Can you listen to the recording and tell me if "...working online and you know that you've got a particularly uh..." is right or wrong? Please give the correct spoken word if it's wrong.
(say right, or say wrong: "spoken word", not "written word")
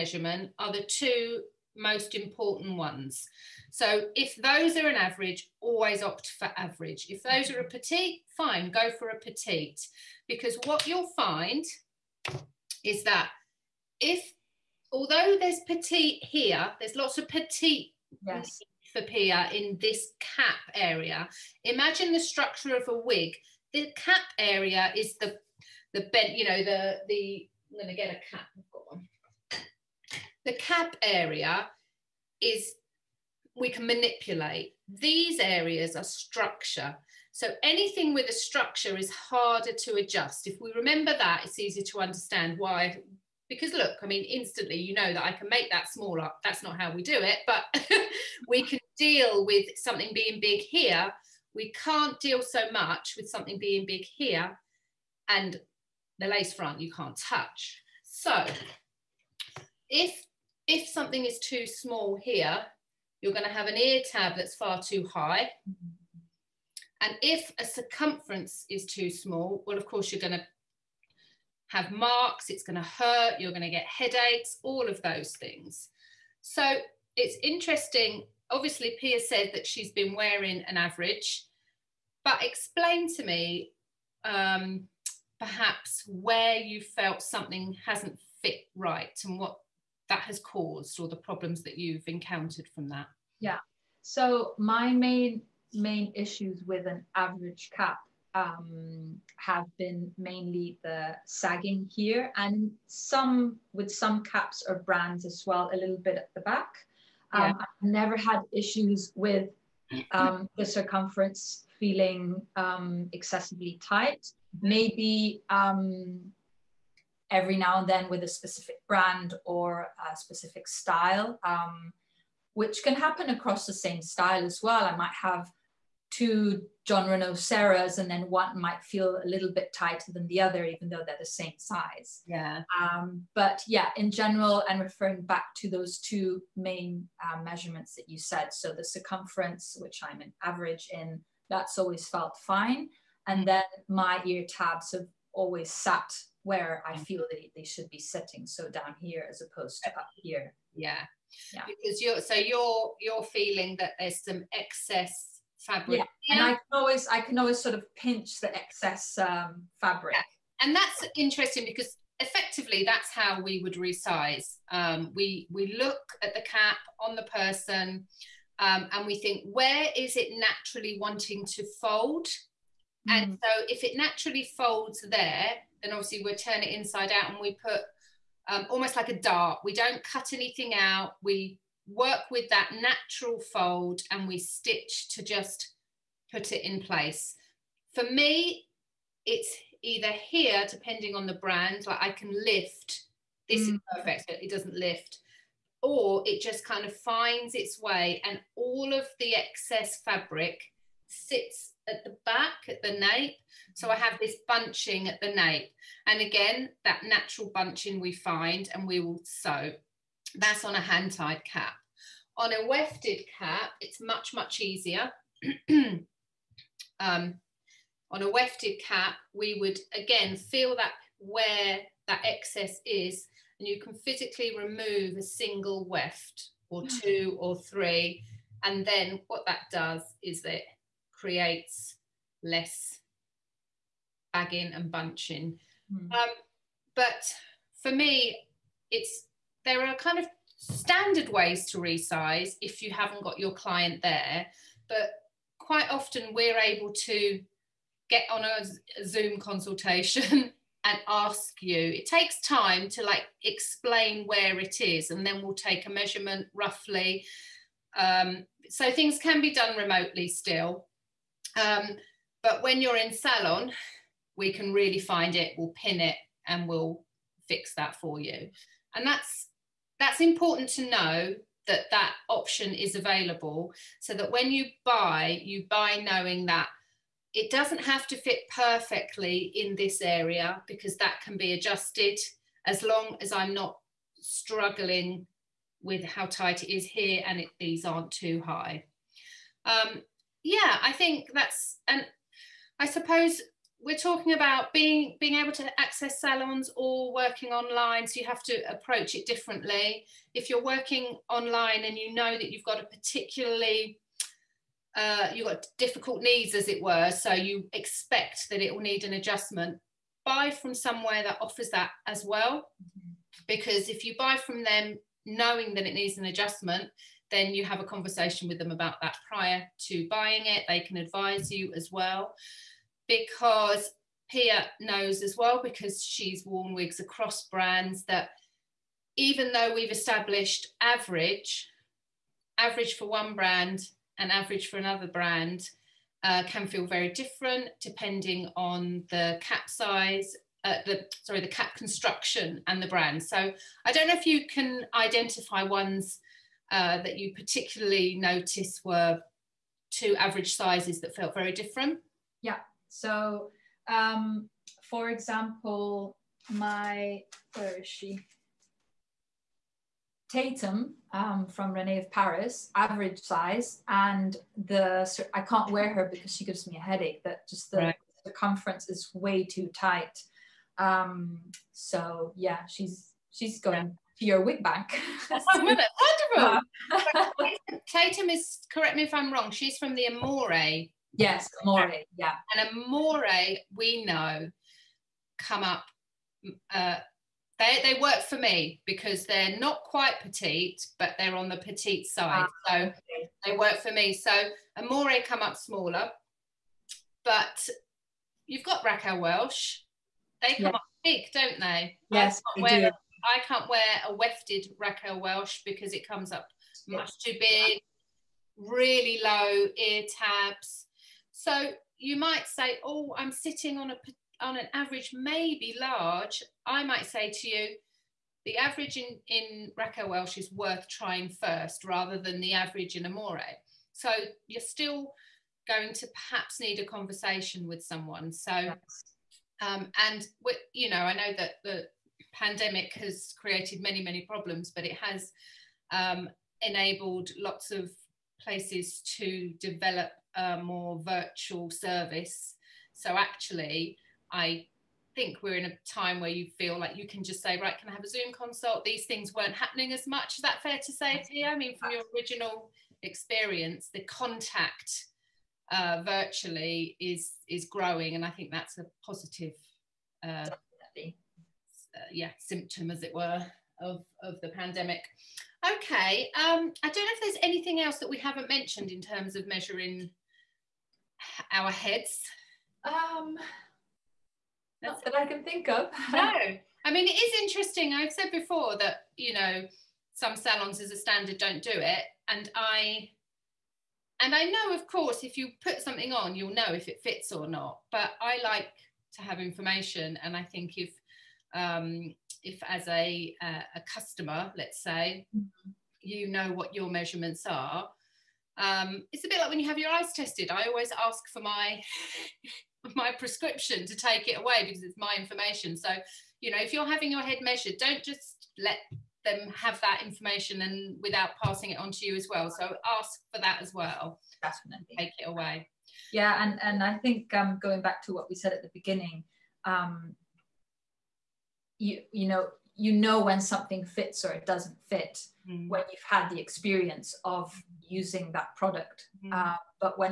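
right.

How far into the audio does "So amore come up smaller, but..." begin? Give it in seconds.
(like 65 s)
394 s.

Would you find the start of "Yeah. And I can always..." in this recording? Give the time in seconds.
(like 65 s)
156 s.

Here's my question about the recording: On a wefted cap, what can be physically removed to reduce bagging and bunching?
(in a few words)
A single weft.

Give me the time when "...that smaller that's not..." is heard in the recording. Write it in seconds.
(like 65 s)
45 s.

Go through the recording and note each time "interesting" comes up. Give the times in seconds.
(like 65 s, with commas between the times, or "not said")
77 s, 161 s, 477 s.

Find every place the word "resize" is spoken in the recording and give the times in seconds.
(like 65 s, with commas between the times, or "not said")
163 s, 241 s.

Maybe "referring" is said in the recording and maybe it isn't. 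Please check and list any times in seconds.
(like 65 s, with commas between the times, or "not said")
134 s.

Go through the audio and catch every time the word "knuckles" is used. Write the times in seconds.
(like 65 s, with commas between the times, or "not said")
not said.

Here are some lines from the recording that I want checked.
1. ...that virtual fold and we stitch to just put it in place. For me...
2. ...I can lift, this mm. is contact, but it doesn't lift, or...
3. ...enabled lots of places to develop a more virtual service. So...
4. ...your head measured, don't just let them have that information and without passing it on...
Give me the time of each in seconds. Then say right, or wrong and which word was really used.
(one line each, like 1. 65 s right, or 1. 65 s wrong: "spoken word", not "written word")
1. 182 s wrong: "natural", not "virtual"
2. 192 s wrong: "perfect", not "contact"
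3. 436 s right
4. 507 s right.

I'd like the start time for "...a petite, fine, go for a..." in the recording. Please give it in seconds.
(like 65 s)
7 s.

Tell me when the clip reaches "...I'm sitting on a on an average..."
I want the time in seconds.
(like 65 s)
413 s.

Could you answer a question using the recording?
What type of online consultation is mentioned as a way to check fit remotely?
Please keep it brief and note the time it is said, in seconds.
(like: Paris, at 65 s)
Zoom consultation, at 249 s.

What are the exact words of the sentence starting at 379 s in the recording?
She's from the Amore Yes, amore, yeah.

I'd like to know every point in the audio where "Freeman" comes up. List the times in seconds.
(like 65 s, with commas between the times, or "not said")
not said.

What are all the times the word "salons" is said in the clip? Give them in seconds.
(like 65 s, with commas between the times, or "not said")
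263 s, 296 s, 480 s.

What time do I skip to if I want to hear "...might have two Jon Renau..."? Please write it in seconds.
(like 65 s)
124 s.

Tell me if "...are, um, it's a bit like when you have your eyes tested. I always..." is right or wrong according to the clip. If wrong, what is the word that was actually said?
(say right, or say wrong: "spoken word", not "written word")
right.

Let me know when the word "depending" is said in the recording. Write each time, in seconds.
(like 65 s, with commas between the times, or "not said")
190 s, 337 s.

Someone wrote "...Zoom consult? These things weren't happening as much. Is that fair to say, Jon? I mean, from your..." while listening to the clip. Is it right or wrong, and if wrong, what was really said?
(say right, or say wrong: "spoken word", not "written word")
wrong: "Tia", not "Jon".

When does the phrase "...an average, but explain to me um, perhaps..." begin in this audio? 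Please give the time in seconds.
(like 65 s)
80 s.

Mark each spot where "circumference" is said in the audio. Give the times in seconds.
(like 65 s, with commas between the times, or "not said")
67 s, 110 s, 138 s, 368 s.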